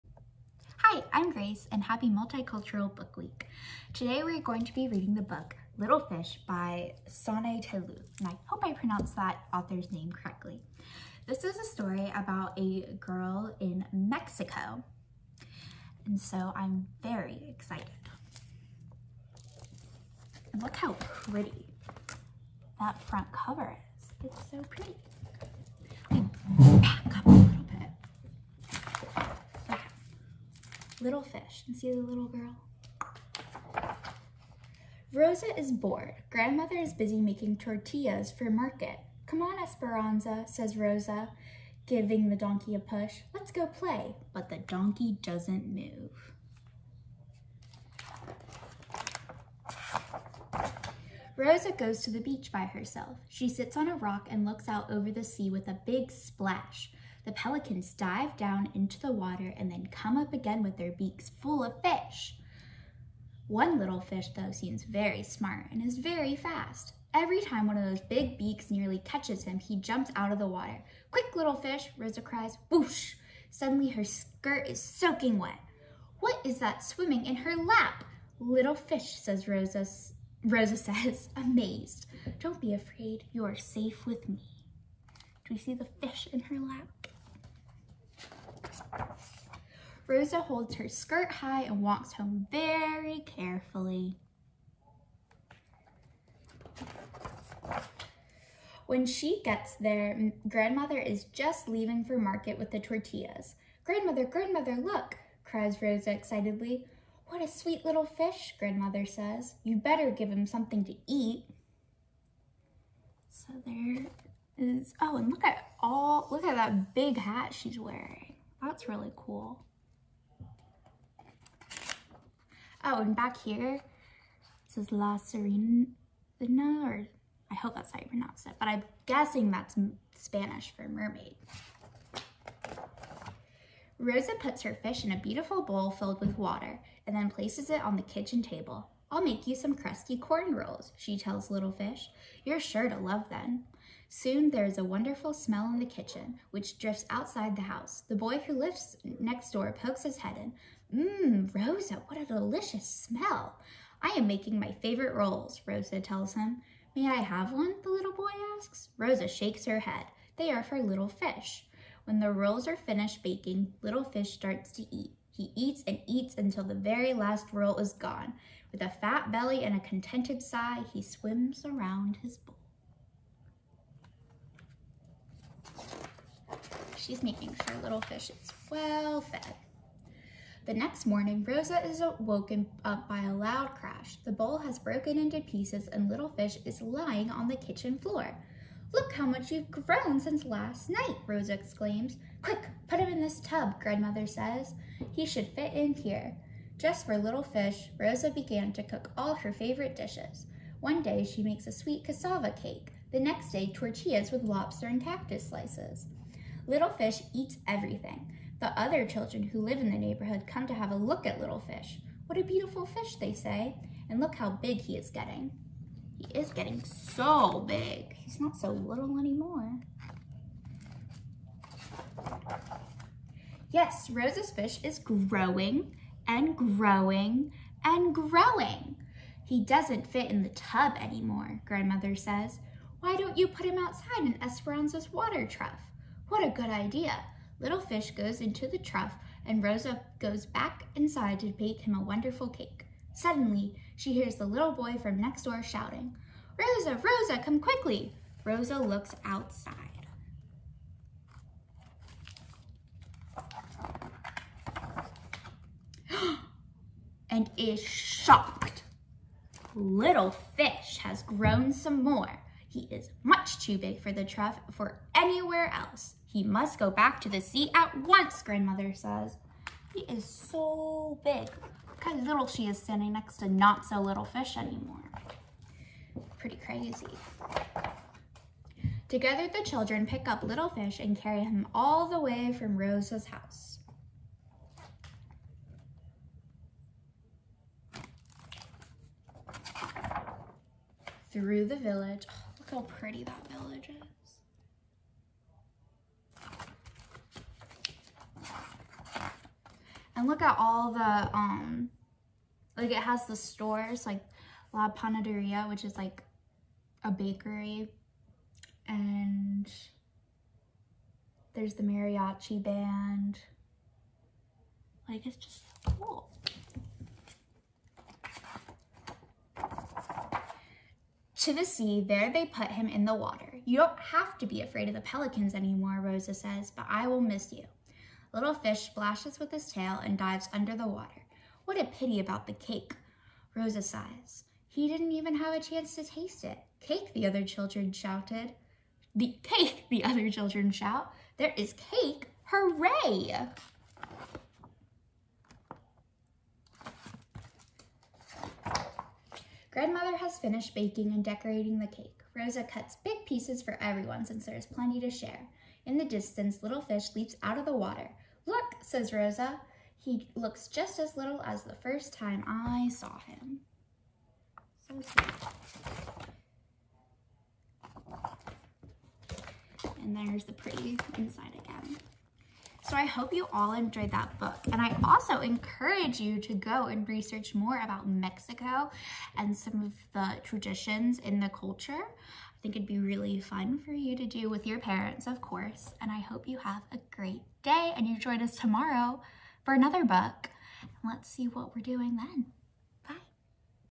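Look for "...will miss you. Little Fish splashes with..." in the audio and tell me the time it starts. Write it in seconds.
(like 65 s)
327 s.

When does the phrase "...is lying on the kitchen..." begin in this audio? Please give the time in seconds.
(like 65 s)
186 s.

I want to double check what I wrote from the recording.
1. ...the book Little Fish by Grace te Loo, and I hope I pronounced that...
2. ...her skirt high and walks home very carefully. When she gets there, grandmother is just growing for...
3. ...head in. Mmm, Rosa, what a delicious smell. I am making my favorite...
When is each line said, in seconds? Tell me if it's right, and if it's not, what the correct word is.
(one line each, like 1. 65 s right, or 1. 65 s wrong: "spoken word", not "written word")
1. 5 s wrong: "Sanne", not "Grace"
2. 90 s wrong: "leaving", not "growing"
3. 150 s right.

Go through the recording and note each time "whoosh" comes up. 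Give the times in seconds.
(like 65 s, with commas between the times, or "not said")
72 s.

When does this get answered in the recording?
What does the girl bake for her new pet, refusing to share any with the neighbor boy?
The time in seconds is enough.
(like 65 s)
139 s.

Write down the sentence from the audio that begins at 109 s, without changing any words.
You better give him something to eat.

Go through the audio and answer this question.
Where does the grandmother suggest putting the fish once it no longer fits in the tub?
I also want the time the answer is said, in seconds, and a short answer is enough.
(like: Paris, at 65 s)
Water trough, at 235 s.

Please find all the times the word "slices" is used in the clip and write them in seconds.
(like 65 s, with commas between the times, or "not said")
205 s.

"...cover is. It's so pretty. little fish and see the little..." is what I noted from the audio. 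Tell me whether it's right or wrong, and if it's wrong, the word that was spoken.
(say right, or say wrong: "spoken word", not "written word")
right.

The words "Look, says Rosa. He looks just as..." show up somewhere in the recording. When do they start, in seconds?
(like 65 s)
358 s.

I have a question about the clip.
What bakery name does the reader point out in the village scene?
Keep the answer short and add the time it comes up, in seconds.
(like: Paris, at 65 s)
La Panaderia, at 304 s.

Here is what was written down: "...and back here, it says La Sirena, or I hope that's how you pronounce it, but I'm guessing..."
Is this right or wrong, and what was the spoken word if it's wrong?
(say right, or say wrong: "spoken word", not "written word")
right.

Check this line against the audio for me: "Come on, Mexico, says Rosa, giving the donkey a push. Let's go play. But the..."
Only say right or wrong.
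wrong.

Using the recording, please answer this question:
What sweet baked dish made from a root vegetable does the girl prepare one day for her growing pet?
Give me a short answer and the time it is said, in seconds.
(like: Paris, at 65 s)
Cassava cake, at 202 s.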